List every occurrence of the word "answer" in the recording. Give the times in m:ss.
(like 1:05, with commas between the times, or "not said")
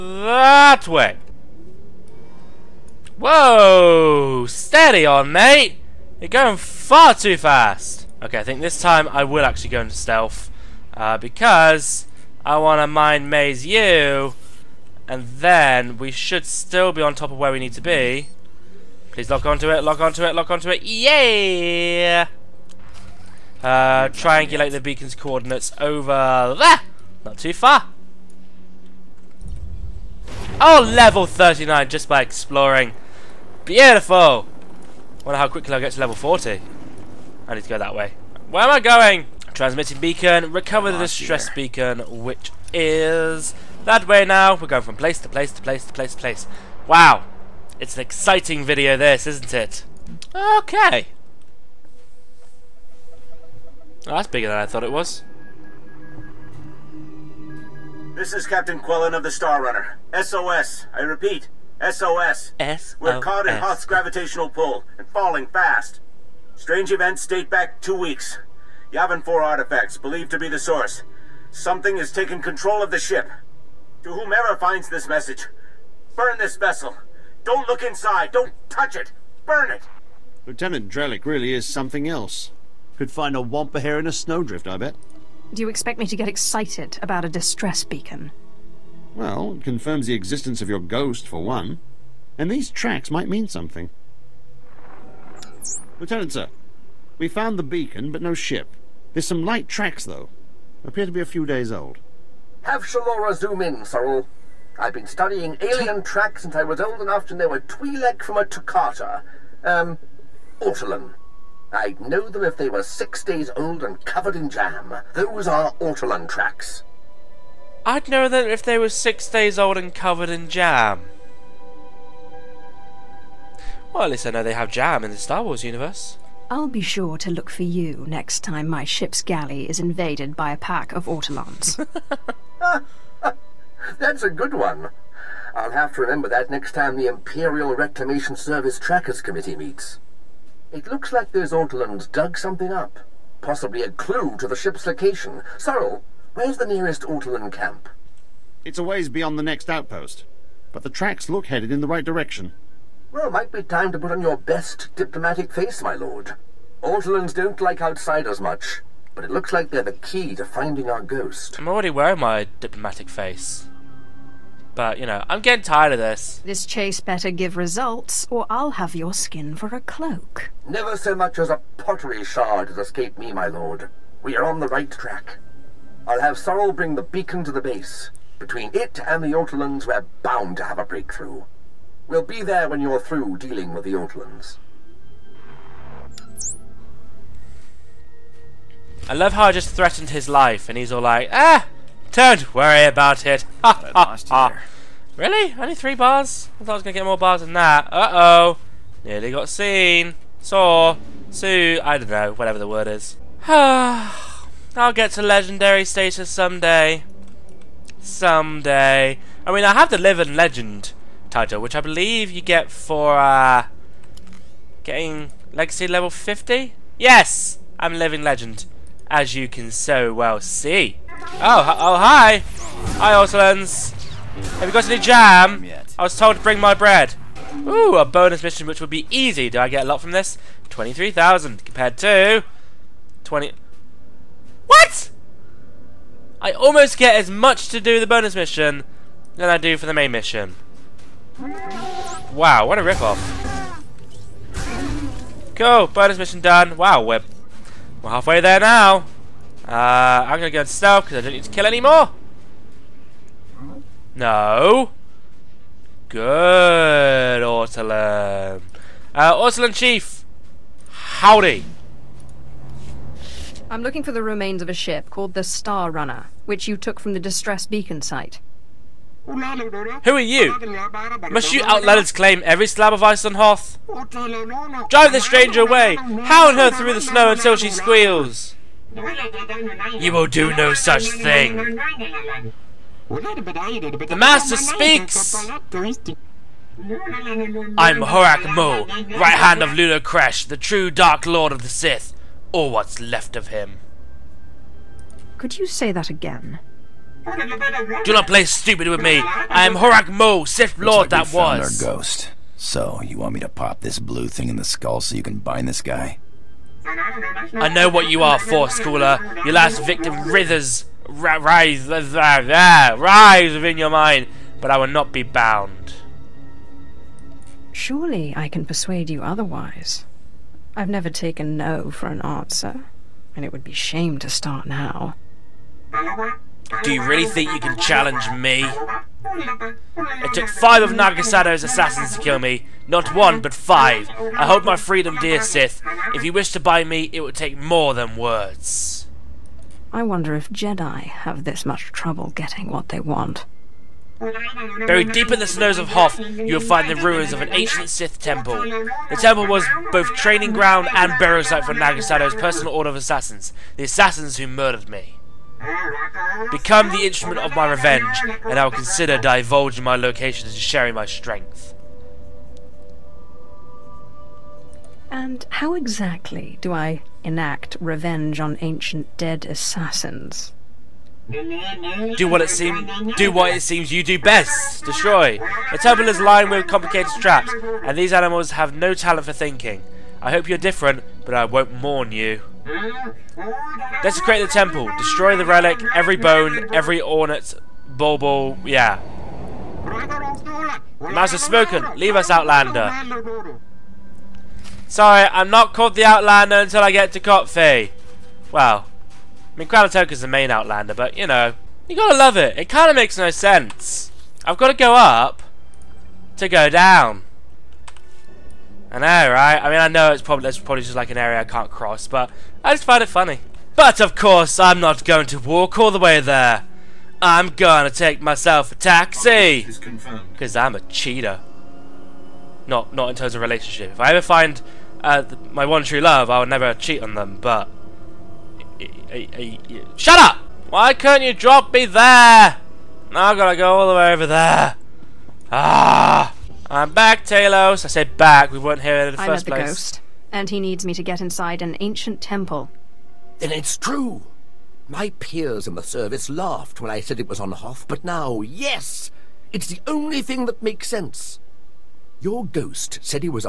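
5:22.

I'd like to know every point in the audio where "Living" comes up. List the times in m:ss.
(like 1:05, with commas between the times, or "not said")
3:29, 3:37.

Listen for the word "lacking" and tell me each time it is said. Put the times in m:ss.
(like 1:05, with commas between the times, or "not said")
not said.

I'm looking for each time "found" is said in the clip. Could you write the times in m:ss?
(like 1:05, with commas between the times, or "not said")
1:37, 5:01.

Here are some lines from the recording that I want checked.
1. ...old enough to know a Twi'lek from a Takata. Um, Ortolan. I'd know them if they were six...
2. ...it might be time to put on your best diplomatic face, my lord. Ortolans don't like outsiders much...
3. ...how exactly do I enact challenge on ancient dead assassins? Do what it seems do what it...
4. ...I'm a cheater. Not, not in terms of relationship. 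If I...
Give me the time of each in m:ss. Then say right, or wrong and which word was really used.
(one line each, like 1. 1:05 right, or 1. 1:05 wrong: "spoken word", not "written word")
1. 1:46 right
2. 2:33 right
3. 6:05 wrong: "revenge", not "challenge"
4. 7:00 right.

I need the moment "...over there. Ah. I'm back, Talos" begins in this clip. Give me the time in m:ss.
7:14.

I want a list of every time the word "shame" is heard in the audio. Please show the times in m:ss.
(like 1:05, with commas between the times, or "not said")
5:23.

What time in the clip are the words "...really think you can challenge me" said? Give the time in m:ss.
5:27.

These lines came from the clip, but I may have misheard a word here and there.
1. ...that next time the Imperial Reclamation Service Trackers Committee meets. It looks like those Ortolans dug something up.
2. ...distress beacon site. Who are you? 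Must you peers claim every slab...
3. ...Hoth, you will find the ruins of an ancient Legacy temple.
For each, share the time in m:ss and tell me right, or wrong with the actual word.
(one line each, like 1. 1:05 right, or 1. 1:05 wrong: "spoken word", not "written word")
1. 2:16 right
2. 4:27 wrong: "outlanders", not "peers"
3. 5:45 wrong: "Sith", not "Legacy".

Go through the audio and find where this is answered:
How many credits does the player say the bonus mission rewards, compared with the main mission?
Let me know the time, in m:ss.
3:50.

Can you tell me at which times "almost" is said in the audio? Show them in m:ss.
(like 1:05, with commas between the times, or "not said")
3:56.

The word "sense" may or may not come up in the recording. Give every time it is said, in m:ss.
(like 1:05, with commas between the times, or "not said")
6:43, 7:30.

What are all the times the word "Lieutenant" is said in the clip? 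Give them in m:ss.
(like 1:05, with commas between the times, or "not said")
1:20, 1:35.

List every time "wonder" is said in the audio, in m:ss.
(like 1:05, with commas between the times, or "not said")
0:35, 5:40.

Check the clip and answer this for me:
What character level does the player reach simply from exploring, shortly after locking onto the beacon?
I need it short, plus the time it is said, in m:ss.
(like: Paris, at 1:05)
39, at 0:30.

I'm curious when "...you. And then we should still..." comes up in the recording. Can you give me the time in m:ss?
0:13.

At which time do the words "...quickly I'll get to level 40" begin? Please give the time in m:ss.
0:35.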